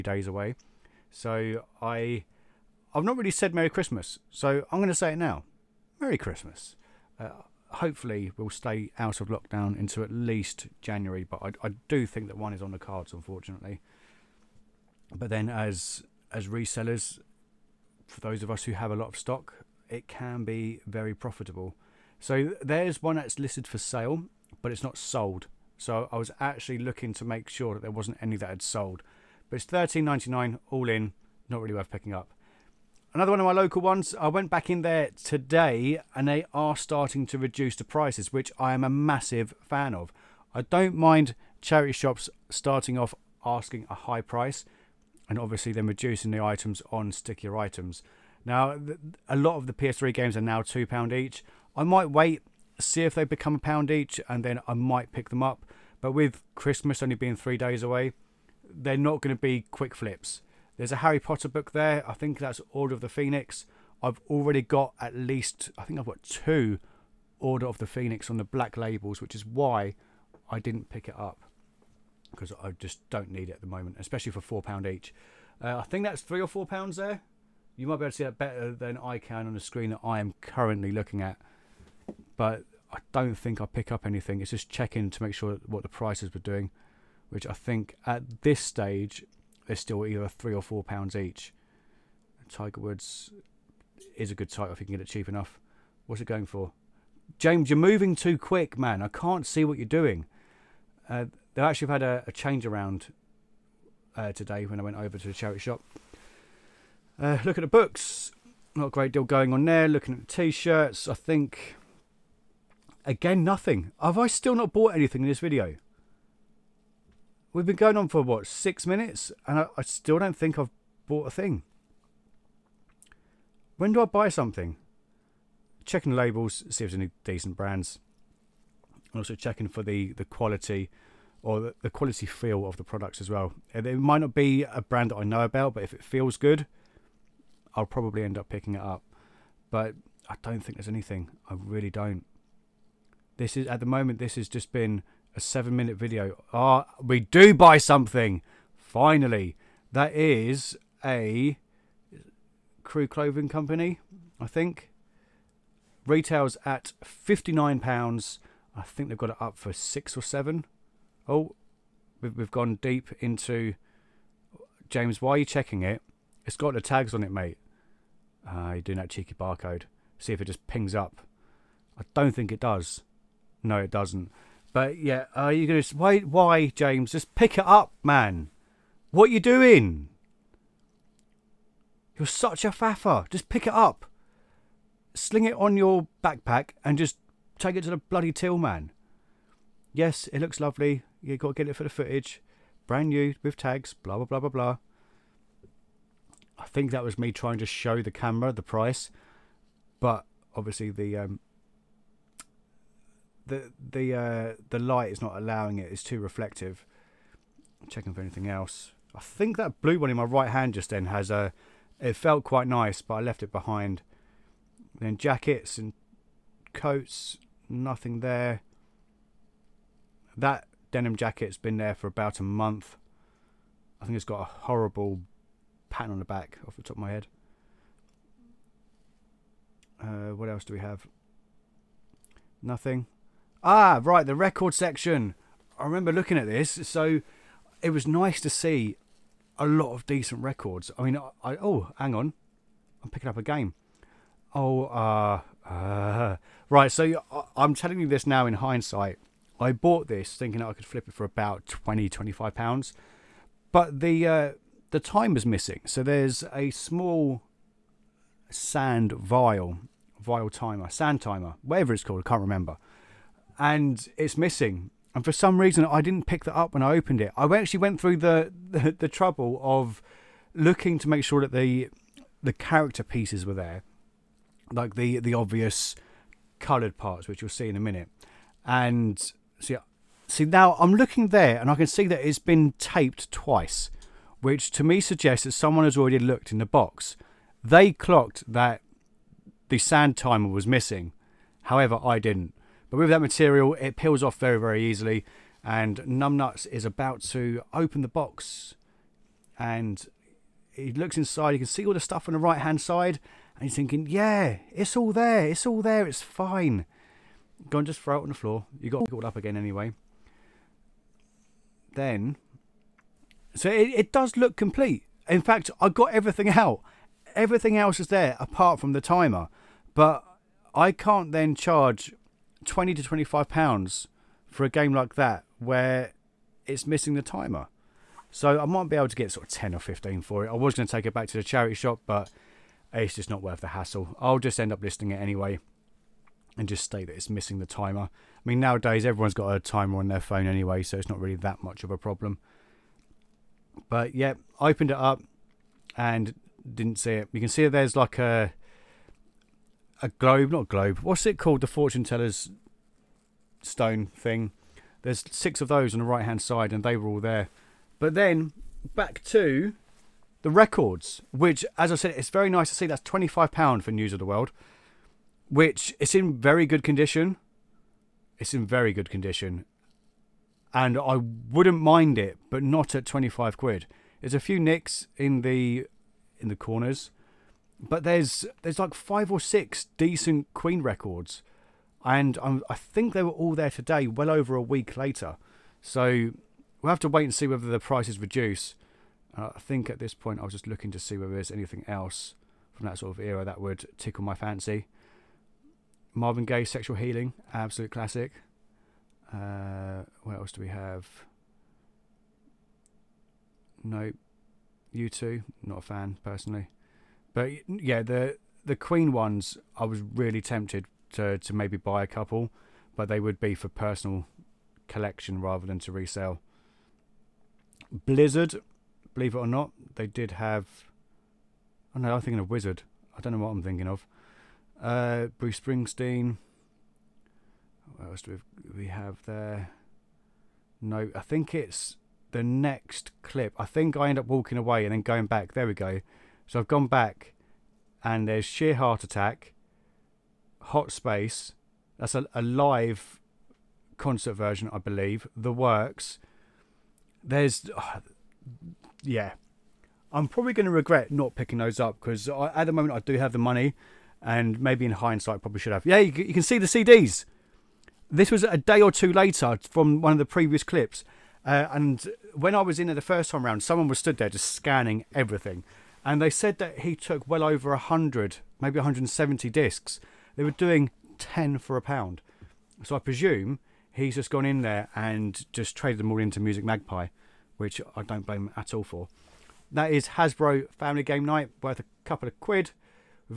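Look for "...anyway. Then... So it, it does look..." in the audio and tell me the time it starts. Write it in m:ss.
5:09.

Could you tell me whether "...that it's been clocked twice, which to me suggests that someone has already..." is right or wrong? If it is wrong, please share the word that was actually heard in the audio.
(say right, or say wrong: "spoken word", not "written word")
wrong: "taped", not "clocked".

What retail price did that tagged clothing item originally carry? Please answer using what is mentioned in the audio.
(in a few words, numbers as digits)
£59.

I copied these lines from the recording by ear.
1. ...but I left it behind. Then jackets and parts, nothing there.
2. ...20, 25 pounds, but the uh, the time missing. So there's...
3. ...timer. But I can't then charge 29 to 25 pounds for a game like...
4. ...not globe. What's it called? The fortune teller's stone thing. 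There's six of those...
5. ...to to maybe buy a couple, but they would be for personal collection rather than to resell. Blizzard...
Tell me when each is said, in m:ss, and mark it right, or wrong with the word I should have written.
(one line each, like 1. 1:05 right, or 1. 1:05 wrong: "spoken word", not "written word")
1. 3:33 wrong: "coats", not "parts"
2. 4:11 right
3. 5:19 wrong: "20", not "29"
4. 5:50 right
5. 6:51 right.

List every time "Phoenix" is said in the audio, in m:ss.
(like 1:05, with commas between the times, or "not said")
1:03, 1:07.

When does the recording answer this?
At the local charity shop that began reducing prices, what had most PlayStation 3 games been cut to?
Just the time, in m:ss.
0:50.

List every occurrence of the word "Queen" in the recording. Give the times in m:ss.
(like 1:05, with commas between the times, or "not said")
6:20, 6:48.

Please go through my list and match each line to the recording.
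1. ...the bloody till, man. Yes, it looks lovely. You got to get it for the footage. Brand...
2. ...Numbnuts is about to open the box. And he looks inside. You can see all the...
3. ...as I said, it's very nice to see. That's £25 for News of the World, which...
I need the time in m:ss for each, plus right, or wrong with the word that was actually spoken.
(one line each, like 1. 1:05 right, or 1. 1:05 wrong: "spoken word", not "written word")
1. 3:07 right
2. 4:56 right
3. 6:01 right.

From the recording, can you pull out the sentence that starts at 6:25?
So we'll have to wait and see whether the prices reduce.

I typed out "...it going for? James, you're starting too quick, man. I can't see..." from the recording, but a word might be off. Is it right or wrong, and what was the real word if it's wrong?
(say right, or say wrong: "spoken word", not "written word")
wrong: "moving", not "starting".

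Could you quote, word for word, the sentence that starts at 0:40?
I don't mind charity shops starting off asking a high price and obviously then reducing the items on stickier items.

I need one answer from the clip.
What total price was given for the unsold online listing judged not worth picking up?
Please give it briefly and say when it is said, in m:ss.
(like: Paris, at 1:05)
£13.99, at 0:29.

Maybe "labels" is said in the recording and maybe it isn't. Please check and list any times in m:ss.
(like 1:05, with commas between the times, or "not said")
1:08, 2:06.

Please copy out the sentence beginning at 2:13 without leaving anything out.
It might not be a brand that I know about, but if it feels good, I'll probably end up picking it up.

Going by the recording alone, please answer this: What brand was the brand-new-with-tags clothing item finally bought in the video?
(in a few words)
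Crew Clothing Company.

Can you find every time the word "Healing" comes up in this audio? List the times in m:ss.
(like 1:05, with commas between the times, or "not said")
6:36.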